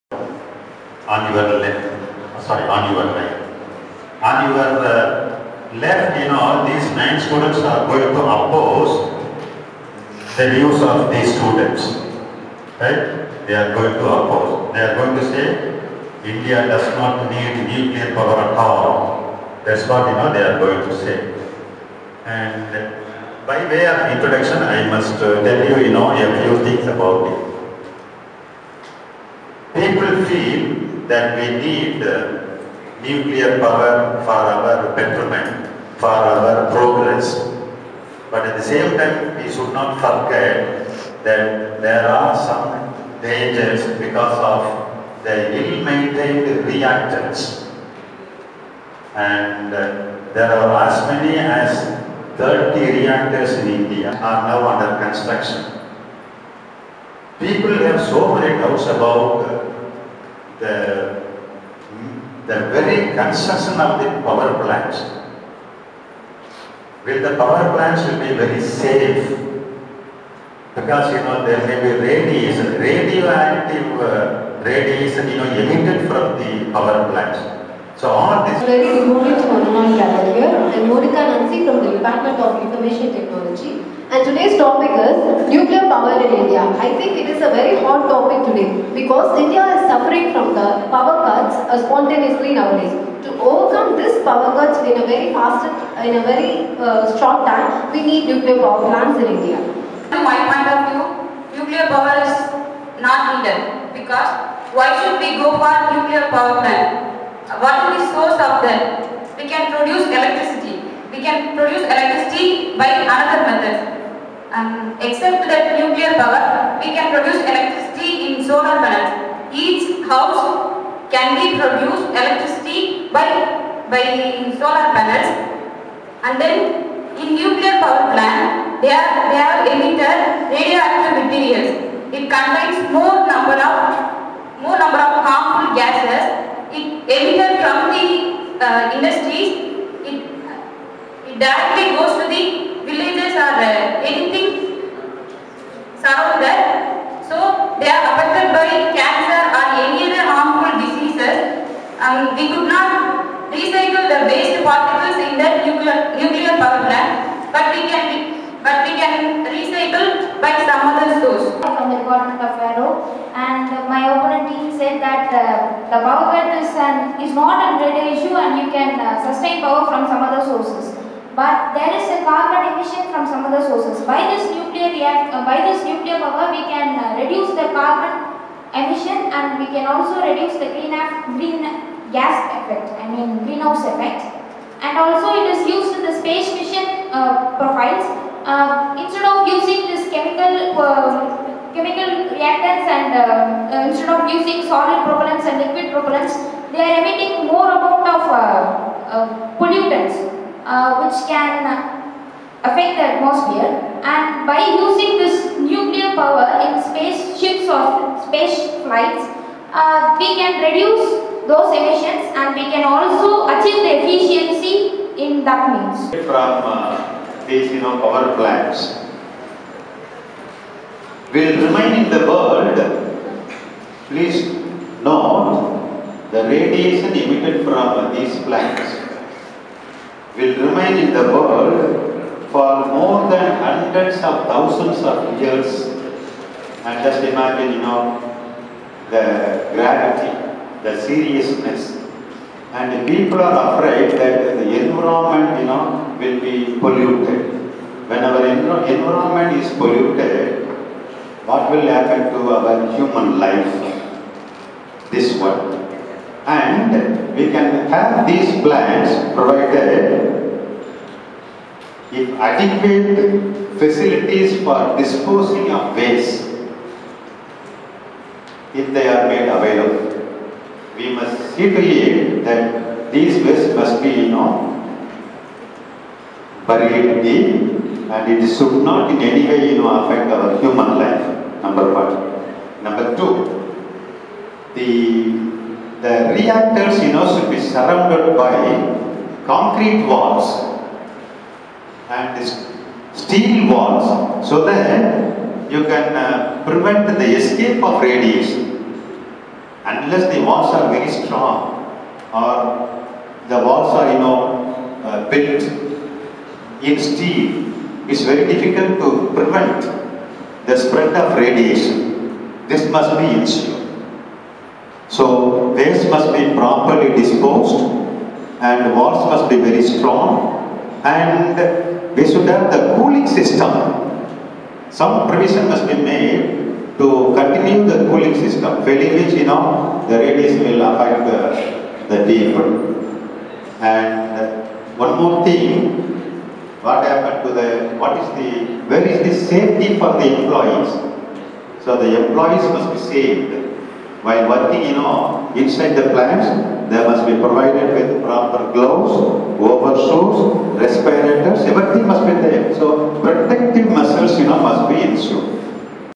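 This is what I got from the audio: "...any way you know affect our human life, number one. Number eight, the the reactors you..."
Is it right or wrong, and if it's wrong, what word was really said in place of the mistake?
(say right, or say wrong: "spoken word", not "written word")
wrong: "two", not "eight".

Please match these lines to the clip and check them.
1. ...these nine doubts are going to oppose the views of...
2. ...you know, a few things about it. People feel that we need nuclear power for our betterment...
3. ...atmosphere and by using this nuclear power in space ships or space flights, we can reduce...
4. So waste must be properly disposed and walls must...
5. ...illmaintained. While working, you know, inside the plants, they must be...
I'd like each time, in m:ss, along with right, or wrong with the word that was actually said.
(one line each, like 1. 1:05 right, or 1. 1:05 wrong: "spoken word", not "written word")
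1. 0:06 wrong: "students", not "doubts"
2. 0:25 right
3. 3:23 right
4. 5:15 right
5. 5:42 wrong: "saved", not "illmaintained".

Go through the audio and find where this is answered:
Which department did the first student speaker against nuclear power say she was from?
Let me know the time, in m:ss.
1:21.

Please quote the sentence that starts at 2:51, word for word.
But there is a carbon emission from some other sources.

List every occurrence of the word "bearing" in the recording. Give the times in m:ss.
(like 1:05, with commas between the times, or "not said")
not said.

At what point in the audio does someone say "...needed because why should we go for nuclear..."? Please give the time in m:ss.
1:43.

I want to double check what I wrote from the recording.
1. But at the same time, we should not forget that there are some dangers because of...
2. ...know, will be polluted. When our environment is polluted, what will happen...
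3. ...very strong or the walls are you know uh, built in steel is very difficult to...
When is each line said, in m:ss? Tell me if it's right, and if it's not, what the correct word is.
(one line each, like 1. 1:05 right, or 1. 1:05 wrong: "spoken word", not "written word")
1. 0:38 right
2. 4:05 right
3. 5:00 right.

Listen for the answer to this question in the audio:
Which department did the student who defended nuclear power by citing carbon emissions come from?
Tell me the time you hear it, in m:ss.
2:42.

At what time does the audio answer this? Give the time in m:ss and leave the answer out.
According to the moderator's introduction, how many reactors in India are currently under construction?
0:52.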